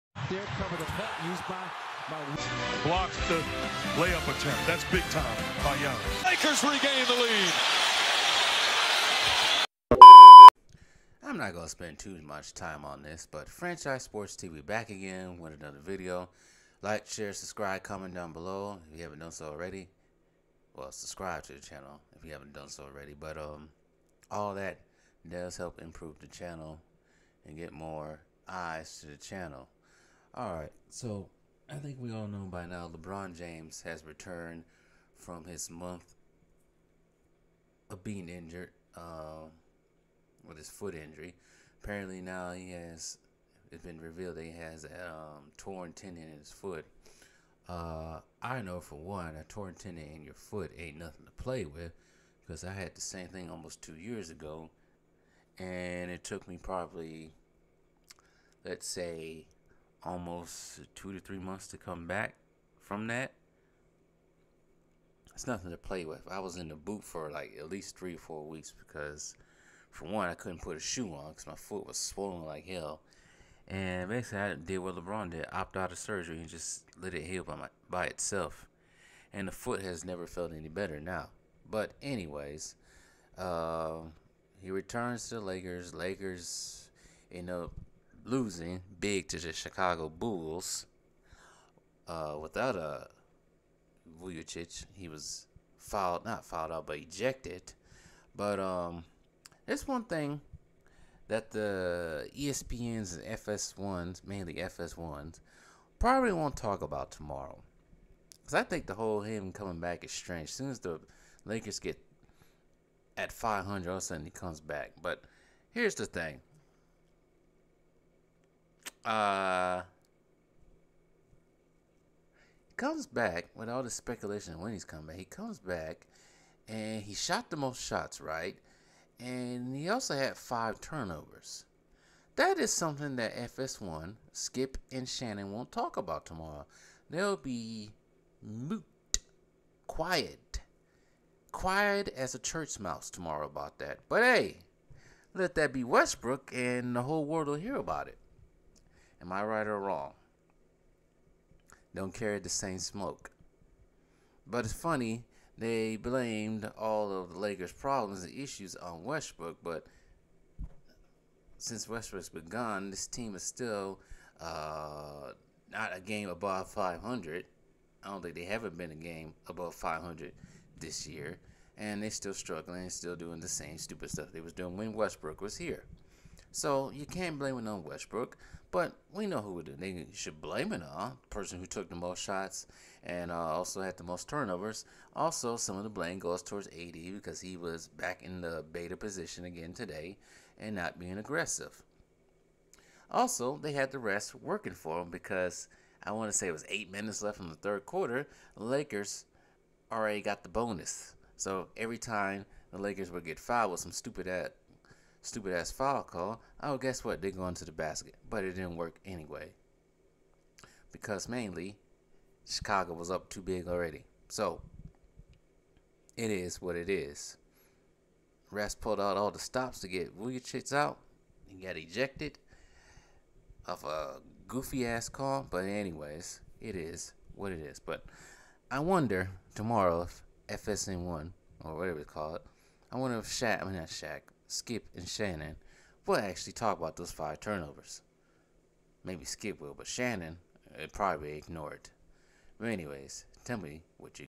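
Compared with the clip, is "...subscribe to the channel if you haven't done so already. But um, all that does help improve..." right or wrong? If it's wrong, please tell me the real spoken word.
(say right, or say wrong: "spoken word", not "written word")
right.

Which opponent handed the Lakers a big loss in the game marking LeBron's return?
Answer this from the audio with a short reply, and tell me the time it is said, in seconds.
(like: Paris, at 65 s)
Chicago Bulls, at 89 s.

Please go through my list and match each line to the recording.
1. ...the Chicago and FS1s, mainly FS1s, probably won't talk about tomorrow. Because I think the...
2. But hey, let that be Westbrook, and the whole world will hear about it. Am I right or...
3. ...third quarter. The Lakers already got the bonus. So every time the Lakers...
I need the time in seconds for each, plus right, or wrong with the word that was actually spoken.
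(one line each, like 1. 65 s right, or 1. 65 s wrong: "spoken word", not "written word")
1. 101 s wrong: "ESPNs", not "Chicago"
2. 144 s right
3. 197 s right.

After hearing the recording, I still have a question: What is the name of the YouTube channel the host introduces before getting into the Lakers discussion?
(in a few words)
Franchise Sports TV.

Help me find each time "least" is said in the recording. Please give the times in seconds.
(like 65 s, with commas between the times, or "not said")
67 s.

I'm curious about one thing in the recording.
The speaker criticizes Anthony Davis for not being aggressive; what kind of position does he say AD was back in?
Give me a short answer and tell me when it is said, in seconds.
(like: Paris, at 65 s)
beta position, at 188 s.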